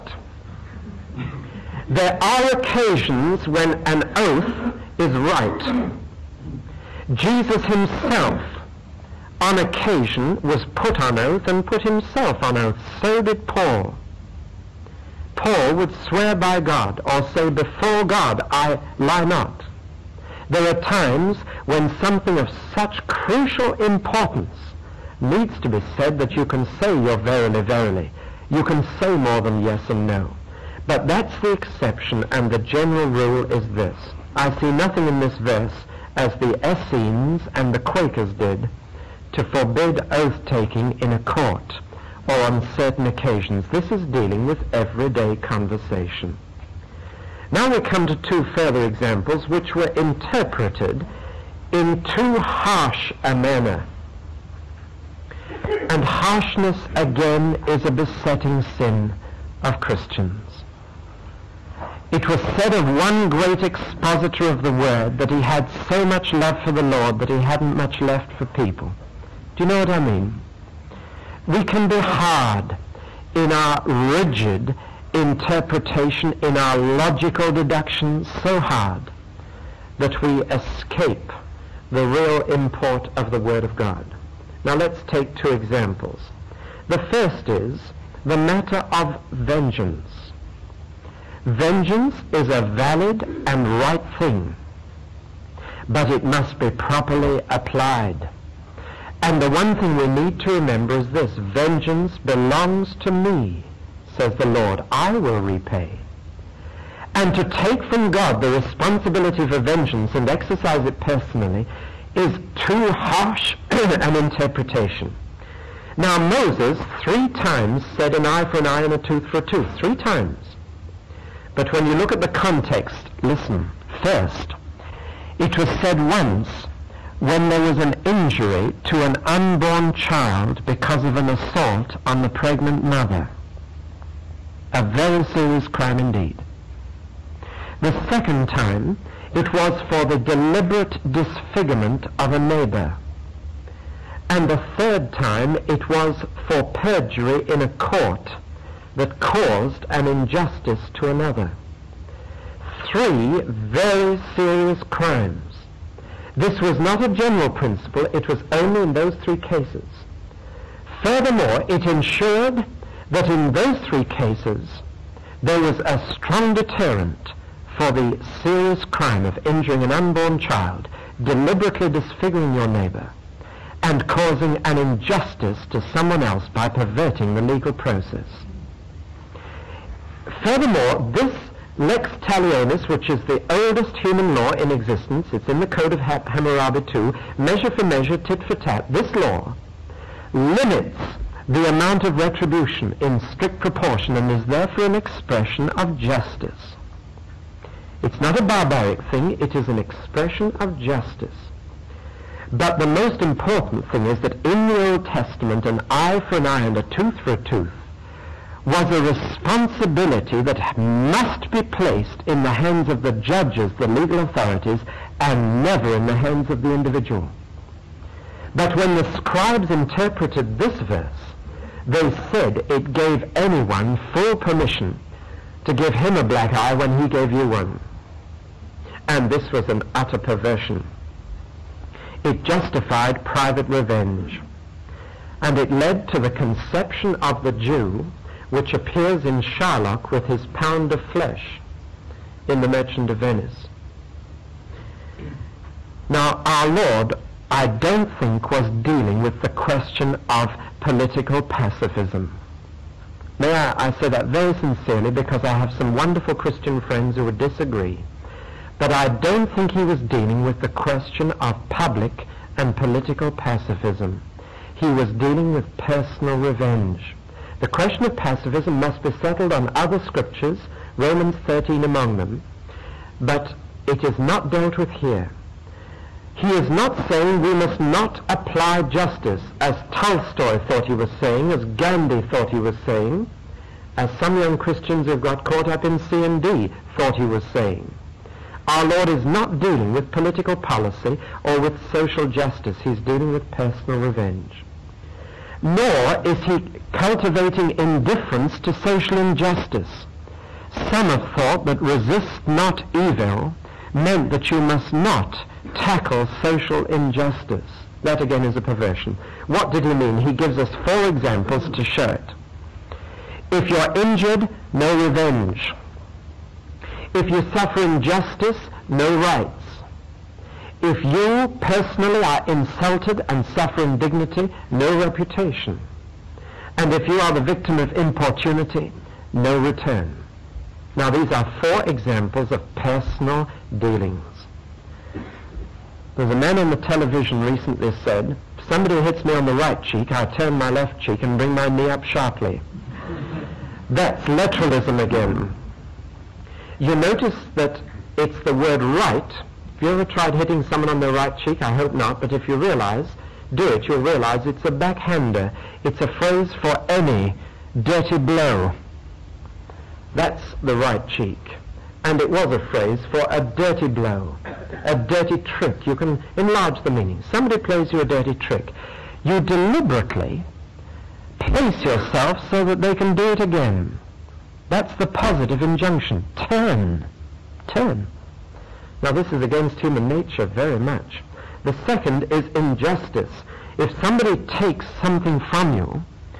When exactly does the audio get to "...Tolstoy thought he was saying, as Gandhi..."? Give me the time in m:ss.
4:39.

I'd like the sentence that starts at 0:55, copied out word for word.
And harshness again is a besetting sin of Christians.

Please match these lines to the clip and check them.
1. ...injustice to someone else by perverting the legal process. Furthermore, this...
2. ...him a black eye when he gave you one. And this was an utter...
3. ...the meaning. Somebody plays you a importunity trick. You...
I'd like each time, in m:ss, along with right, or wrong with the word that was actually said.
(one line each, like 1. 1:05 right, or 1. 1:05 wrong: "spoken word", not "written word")
1. 2:54 right
2. 3:45 right
3. 6:06 wrong: "dirty", not "importunity".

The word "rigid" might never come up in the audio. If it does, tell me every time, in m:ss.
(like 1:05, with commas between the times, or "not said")
1:13.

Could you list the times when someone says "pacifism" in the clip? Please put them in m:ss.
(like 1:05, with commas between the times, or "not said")
4:11, 4:23, 4:28.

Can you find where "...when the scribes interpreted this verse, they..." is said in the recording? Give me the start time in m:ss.
3:38.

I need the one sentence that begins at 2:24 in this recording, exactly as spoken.
And the third time, it was for perjury in a court that caused an injustice to another.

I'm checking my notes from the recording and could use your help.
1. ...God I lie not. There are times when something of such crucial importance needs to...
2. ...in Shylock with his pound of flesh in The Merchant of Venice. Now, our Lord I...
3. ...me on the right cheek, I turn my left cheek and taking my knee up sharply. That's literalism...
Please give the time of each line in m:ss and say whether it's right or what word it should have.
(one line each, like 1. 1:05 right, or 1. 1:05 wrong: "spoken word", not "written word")
1. 0:18 right
2. 3:59 right
3. 5:39 wrong: "bring", not "taking".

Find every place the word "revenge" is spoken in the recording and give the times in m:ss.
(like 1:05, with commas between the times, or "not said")
3:53, 4:26, 4:53, 5:14.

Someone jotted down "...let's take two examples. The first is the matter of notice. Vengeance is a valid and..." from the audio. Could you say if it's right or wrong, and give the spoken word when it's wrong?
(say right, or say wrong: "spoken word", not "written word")
wrong: "vengeance", not "notice".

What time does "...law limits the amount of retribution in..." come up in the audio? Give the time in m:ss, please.
3:09.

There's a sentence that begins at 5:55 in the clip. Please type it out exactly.
It's a phrase for any dirty blow.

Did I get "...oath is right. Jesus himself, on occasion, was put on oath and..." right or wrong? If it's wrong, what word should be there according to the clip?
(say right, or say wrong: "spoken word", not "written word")
right.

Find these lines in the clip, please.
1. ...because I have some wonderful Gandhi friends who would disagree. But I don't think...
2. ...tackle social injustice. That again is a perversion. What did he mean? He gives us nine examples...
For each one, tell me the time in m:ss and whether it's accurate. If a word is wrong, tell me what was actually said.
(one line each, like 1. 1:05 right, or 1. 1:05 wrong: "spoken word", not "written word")
1. 4:15 wrong: "Christian", not "Gandhi"
2. 5:05 wrong: "four", not "nine".